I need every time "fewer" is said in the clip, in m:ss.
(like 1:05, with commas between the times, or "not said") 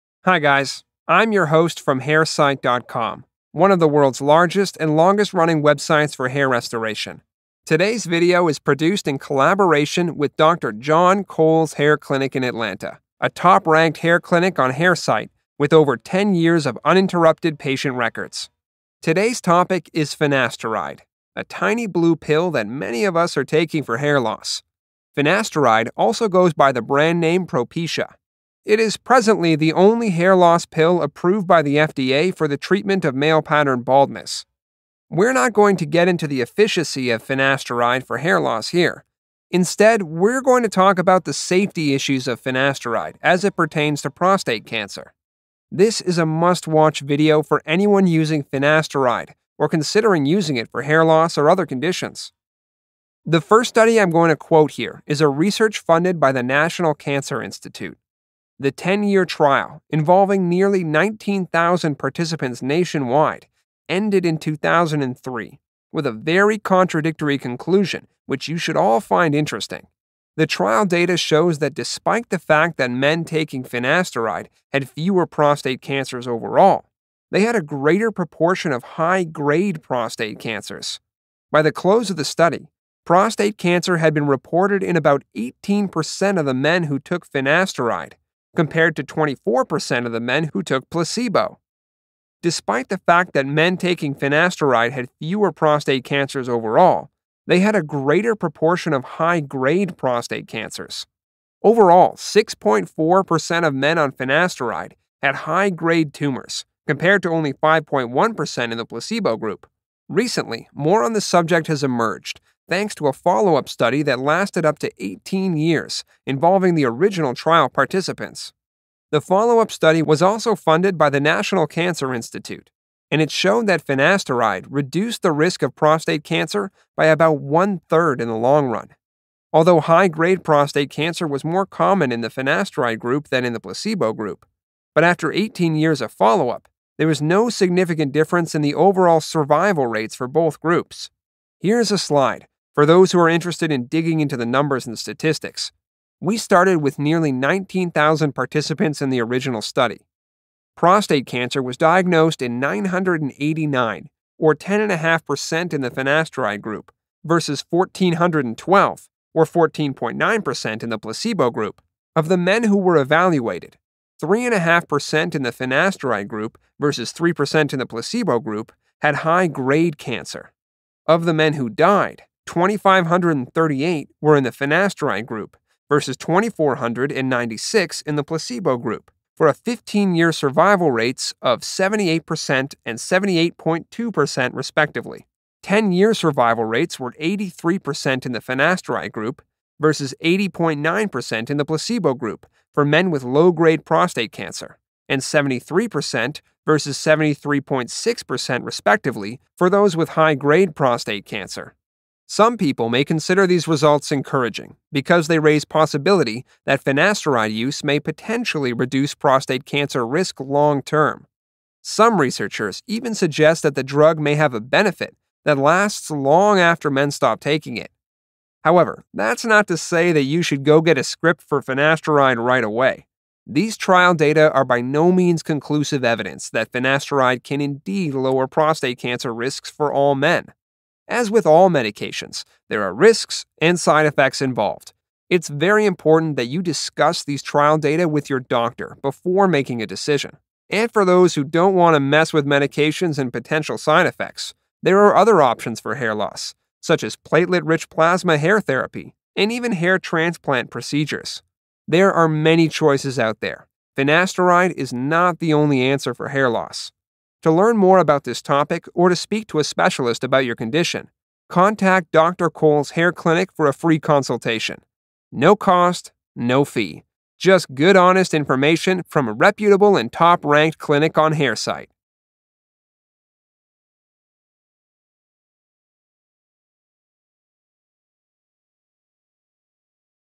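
1:14, 1:35.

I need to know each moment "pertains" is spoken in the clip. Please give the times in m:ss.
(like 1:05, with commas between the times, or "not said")
0:43.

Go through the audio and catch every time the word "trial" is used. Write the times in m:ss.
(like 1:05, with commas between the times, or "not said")
0:59, 1:10, 1:57, 3:43, 3:57.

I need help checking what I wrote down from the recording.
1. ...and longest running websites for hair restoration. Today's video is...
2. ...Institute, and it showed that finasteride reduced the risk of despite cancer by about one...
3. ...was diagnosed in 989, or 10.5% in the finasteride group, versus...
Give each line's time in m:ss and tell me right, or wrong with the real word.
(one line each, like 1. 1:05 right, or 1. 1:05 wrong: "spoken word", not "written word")
1. 0:04 right
2. 2:02 wrong: "prostate", not "despite"
3. 2:31 right.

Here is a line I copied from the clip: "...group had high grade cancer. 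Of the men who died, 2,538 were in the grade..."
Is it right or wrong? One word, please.
wrong.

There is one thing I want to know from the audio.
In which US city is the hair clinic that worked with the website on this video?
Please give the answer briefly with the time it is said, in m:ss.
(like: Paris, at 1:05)
Atlanta, at 0:12.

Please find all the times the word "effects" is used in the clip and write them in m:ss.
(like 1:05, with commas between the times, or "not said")
3:54, 4:04.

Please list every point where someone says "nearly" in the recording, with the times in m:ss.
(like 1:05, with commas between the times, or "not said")
1:00, 2:26.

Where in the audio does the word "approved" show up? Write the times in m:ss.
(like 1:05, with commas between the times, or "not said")
0:31.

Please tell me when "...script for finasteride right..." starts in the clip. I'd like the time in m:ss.
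3:41.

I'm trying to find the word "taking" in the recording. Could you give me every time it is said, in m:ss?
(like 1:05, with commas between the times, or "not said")
0:23, 1:13, 1:33, 3:37.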